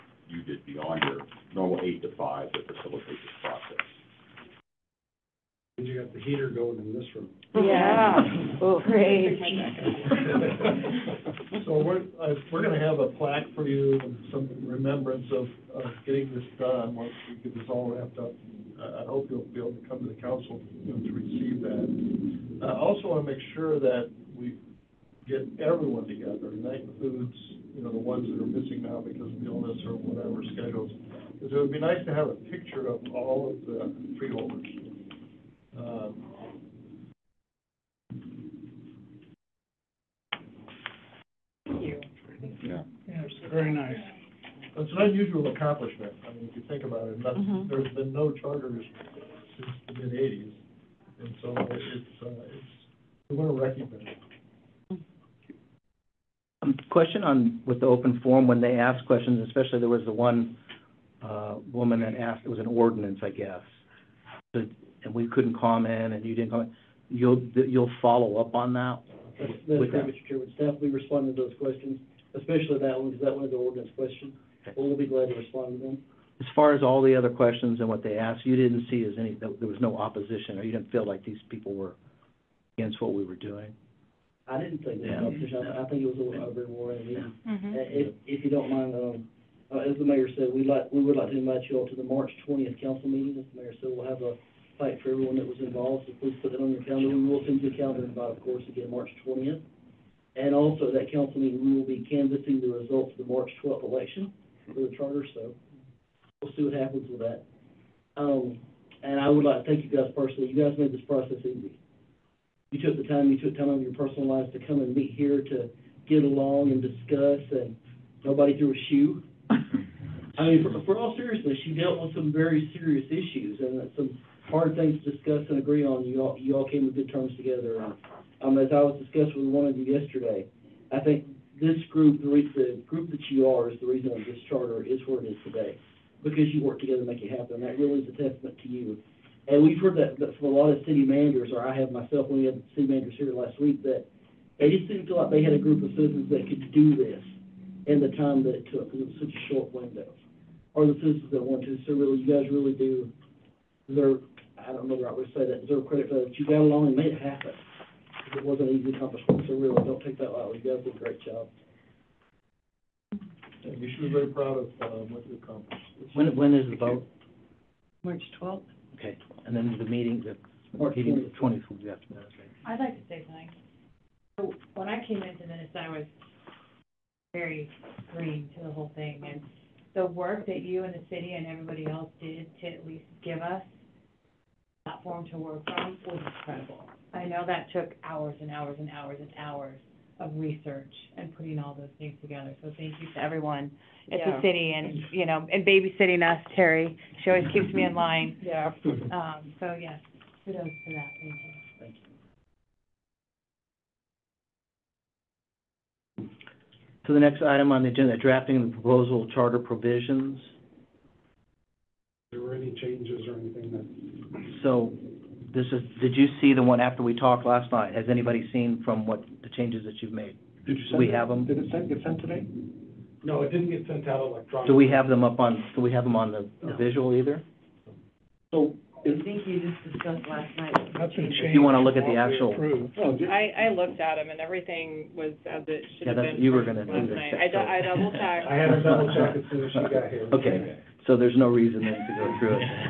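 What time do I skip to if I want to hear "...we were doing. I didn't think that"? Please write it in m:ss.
1:23.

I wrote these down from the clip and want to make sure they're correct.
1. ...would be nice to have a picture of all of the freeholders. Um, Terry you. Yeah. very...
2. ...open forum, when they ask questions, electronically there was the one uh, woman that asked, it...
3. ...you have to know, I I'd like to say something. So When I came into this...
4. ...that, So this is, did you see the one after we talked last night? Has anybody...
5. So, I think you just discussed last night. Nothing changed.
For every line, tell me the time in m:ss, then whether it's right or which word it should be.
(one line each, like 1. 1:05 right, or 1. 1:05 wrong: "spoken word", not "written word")
1. 0:31 wrong: "Thank", not "Terry"
2. 0:57 wrong: "especially", not "electronically"
3. 2:51 right
4. 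3:33 right
5. 3:48 right.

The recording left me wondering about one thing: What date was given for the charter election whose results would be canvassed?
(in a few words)
March 12.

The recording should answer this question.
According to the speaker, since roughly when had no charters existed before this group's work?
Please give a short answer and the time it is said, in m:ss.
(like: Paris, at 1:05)
mid-1980s, at 0:50.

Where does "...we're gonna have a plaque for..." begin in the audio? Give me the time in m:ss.
0:12.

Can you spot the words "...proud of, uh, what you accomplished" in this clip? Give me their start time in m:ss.
2:44.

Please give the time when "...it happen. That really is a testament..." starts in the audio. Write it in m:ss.
2:17.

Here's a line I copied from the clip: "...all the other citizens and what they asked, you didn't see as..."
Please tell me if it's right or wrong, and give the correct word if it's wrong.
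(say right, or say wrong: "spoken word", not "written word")
wrong: "questions", not "citizens".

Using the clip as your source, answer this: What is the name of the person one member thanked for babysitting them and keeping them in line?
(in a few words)
Terry.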